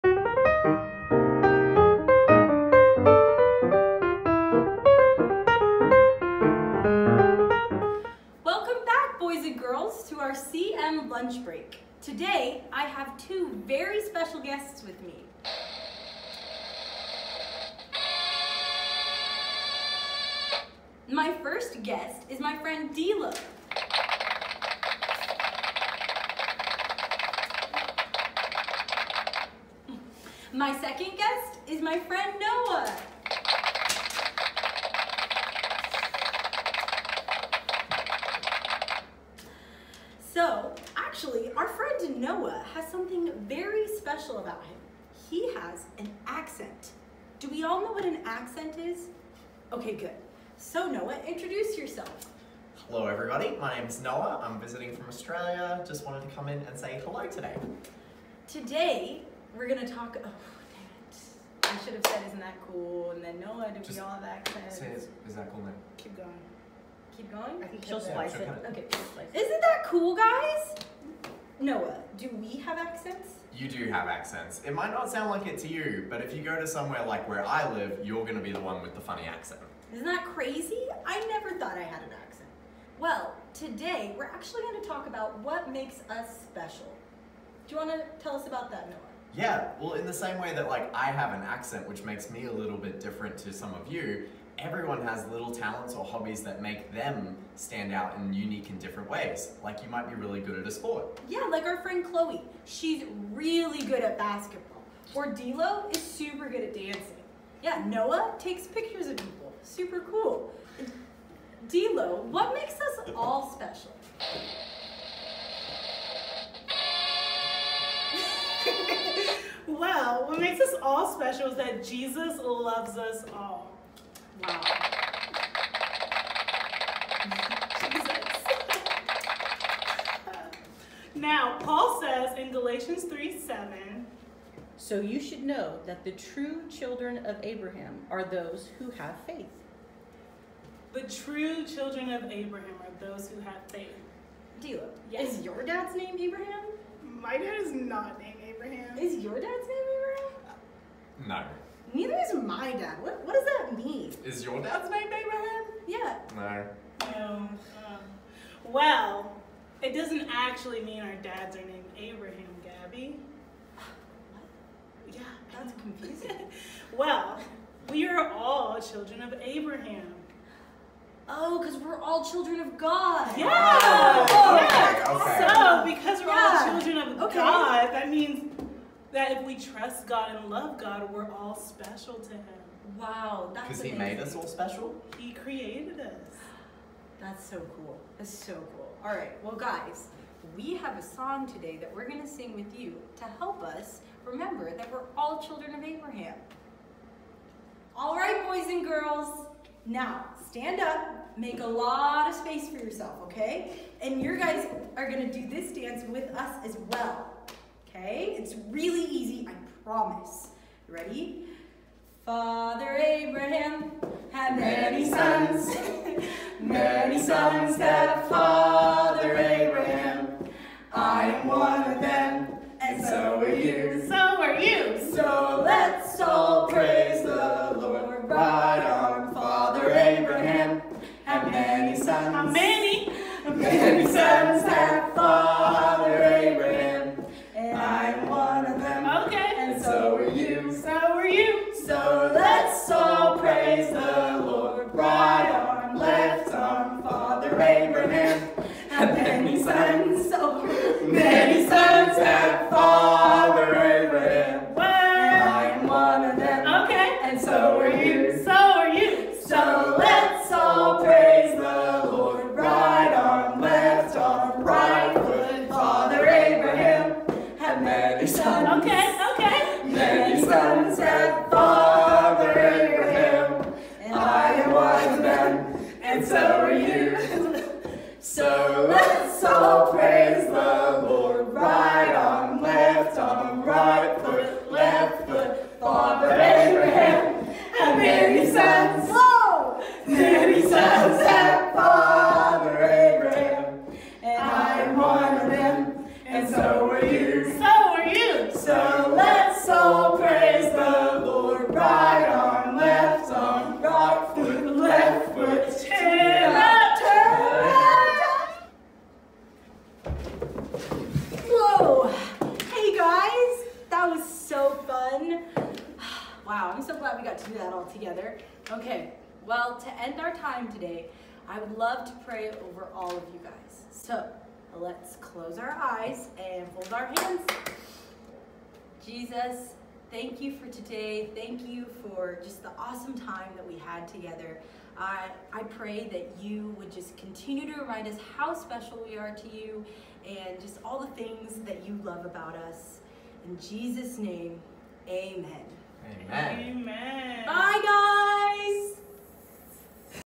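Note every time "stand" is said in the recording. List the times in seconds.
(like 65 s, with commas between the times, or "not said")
97 s, 200 s.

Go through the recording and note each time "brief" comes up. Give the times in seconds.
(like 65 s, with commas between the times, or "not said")
not said.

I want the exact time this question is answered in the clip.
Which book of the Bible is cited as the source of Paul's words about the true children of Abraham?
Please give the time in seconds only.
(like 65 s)
132 s.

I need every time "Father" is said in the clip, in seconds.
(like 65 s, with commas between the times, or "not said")
212 s, 218 s, 229 s, 235 s, 247 s, 285 s, 291 s.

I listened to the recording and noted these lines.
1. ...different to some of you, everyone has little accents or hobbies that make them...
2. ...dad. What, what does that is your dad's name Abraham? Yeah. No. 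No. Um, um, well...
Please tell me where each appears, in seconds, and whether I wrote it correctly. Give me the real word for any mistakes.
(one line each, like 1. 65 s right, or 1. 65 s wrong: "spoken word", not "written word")
1. 92 s wrong: "talents", not "accents"
2. 152 s right.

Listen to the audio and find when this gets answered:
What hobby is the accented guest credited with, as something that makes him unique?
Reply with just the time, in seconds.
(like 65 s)
108 s.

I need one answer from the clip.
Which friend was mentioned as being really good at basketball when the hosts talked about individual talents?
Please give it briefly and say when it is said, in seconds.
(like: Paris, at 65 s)
Chloe, at 102 s.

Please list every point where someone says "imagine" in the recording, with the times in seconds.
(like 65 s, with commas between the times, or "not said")
not said.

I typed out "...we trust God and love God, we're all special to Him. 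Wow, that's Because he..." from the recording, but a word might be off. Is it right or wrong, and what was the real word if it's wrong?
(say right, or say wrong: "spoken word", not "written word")
right.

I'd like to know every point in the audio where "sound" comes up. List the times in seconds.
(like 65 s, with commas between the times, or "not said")
75 s.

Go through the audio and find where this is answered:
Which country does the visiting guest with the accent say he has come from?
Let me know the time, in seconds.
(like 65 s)
55 s.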